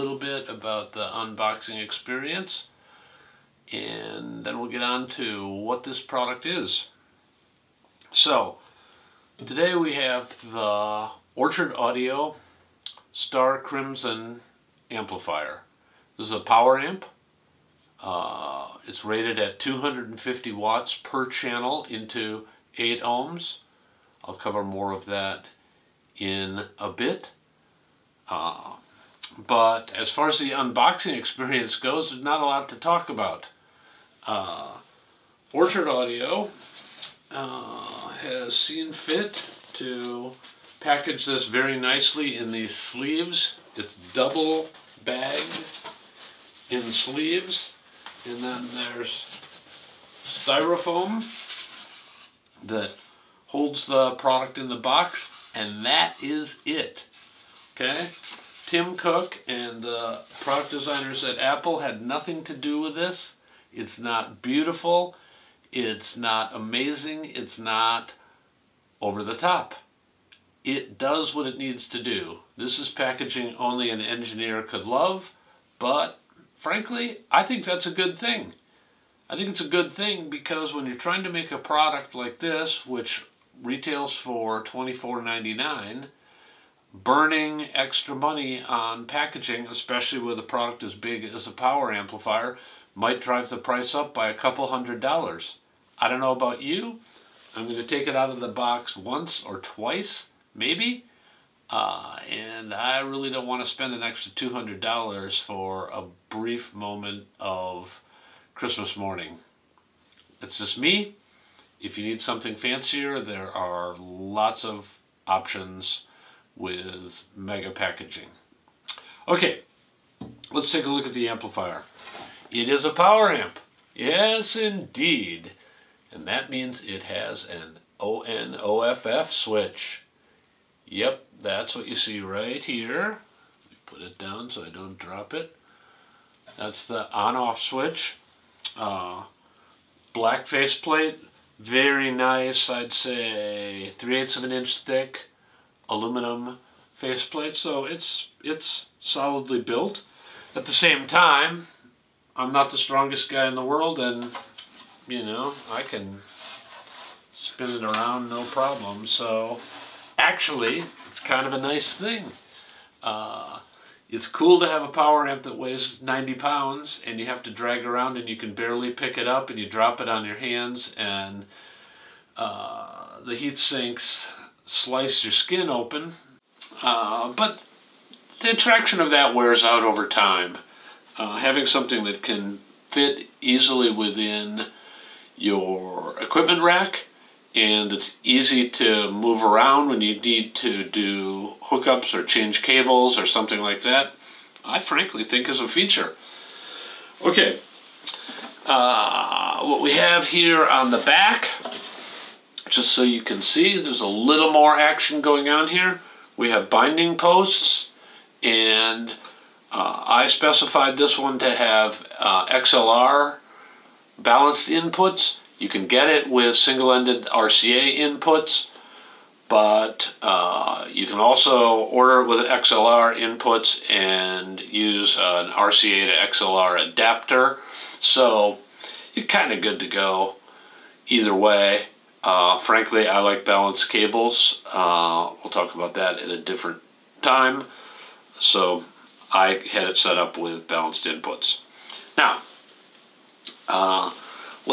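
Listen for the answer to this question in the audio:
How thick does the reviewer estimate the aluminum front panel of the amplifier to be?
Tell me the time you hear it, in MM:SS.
02:23.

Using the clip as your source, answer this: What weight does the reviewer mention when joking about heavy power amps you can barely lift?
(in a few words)
90 pounds.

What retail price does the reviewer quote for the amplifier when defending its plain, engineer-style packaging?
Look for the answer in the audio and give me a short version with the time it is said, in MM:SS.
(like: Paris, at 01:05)
$24.99, at 01:24.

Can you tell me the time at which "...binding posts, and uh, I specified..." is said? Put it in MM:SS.
03:26.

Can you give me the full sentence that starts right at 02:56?
Uh, but the attraction of that wears out over time.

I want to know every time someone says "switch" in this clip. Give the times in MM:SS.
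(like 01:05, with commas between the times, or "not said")
02:09, 02:17.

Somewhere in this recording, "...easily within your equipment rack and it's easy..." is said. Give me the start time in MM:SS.
03:03.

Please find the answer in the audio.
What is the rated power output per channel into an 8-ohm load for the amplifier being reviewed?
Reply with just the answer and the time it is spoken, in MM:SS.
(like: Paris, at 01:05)
250 watts, at 00:19.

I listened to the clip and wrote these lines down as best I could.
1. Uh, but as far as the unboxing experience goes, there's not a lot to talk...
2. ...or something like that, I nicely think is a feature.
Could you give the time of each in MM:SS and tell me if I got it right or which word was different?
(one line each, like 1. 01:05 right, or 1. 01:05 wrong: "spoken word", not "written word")
1. 00:28 right
2. 03:13 wrong: "frankly", not "nicely".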